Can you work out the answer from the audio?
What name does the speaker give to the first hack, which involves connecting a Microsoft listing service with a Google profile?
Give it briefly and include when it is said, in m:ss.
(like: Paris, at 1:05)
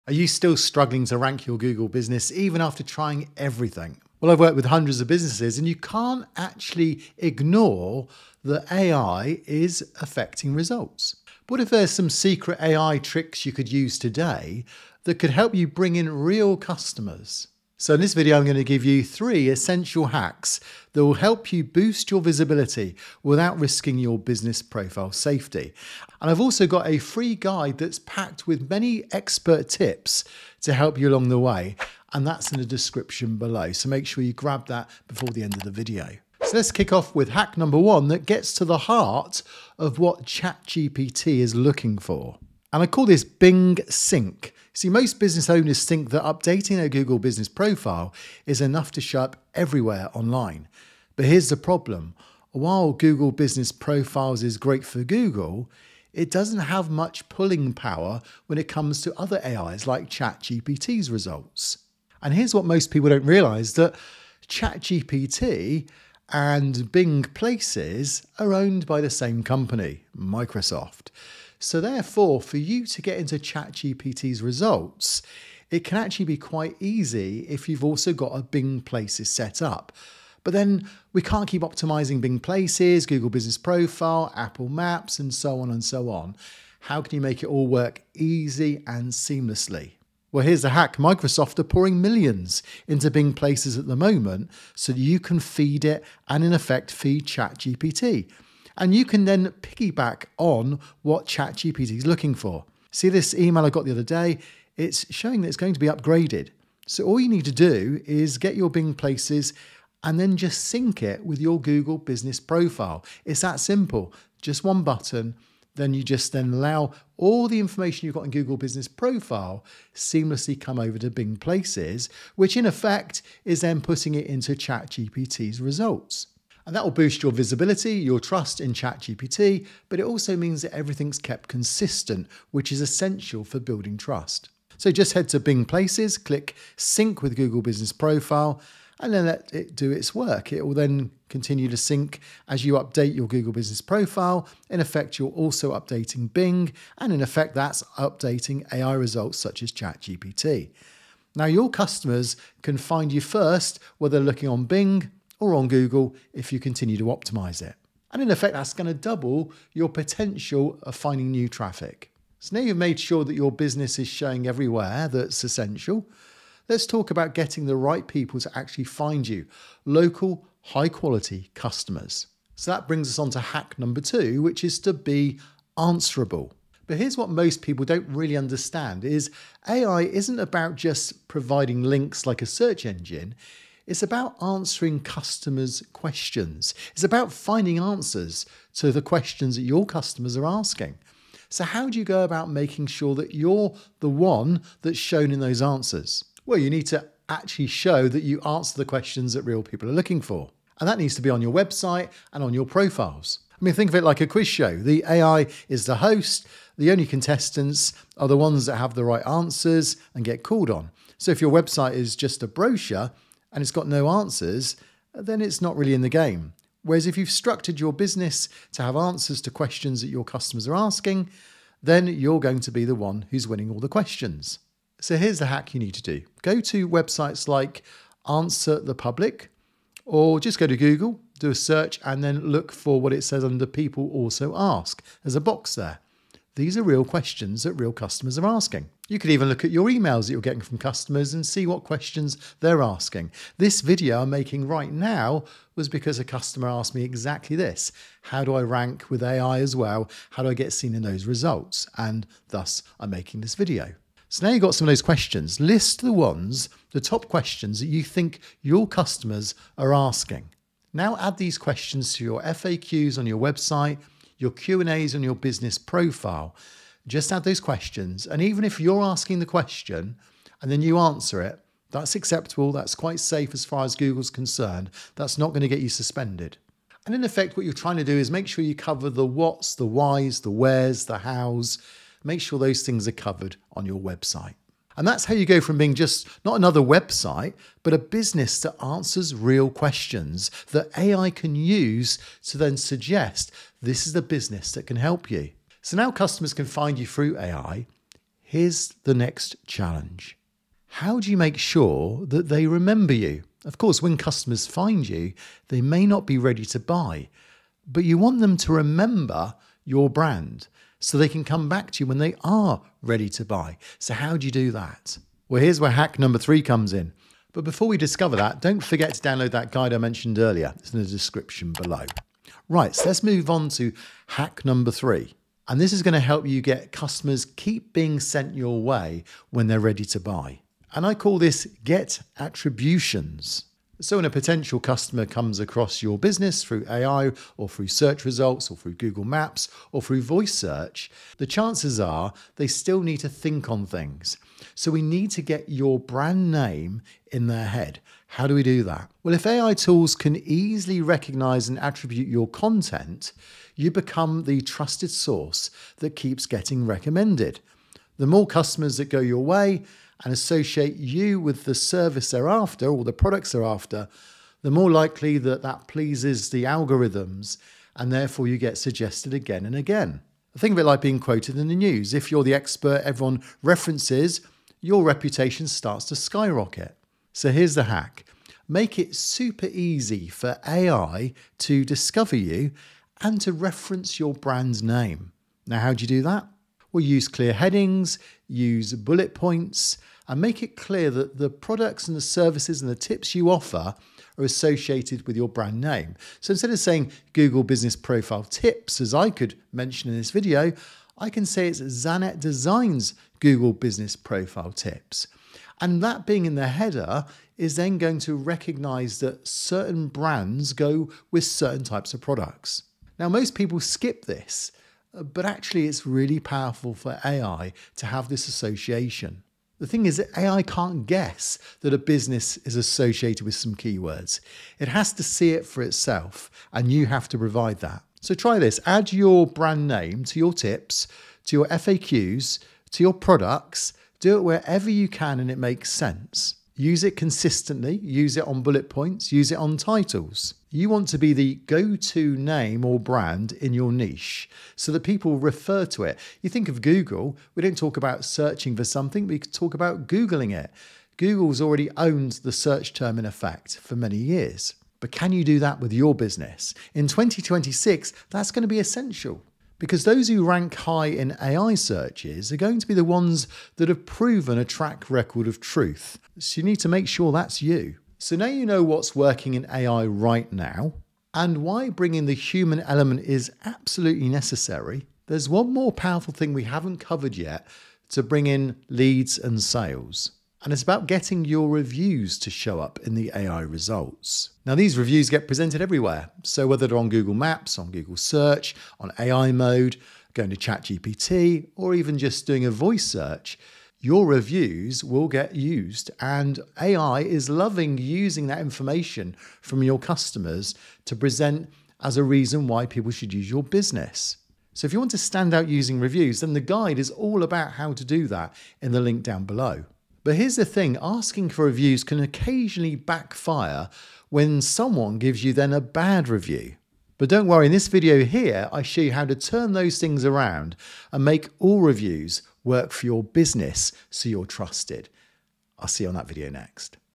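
Bing Sync, at 0:43.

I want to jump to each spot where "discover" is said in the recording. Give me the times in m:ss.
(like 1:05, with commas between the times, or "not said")
5:17, 6:21.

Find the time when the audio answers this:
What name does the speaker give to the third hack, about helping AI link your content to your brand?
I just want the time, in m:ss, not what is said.
5:31.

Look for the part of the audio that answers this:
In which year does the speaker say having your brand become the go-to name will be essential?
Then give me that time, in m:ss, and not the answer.
7:37.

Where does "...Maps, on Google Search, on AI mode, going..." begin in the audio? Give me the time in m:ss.
8:07.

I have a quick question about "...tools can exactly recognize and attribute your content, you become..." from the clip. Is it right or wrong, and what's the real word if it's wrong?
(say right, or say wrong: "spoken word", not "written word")
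wrong: "easily", not "exactly".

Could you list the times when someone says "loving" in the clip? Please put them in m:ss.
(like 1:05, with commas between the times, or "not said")
8:17.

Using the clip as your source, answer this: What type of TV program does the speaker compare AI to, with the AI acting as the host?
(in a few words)
Quiz show.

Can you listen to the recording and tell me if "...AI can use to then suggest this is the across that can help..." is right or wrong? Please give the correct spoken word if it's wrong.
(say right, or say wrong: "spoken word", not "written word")
wrong: "business", not "across".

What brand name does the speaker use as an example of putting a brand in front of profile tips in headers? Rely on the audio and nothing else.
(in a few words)
Zanet Designs.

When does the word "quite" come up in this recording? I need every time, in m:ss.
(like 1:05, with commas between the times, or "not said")
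1:16, 4:32.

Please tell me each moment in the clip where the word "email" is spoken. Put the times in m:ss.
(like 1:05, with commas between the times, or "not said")
1:43, 3:59.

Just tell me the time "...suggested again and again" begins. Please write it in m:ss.
6:08.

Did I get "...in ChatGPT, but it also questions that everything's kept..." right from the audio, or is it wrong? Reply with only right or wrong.
wrong.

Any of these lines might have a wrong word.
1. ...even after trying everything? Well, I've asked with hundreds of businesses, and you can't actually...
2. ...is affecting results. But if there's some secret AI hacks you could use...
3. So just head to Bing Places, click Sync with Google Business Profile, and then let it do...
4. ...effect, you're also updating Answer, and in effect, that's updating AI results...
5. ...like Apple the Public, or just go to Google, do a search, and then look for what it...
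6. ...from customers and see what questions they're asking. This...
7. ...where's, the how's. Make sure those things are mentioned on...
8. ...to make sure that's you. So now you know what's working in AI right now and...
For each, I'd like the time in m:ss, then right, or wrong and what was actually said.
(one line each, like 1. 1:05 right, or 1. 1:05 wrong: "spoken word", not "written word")
1. 0:02 wrong: "worked", not "asked"
2. 0:09 wrong: "tricks", not "hacks"
3. 2:14 right
4. 2:24 wrong: "Bing", not "Answer"
5. 3:47 wrong: "Answer", not "Apple"
6. 4:00 right
7. 4:40 wrong: "covered", not "mentioned"
8. 7:46 right.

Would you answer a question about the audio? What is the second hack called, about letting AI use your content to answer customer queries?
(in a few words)
Be answerable.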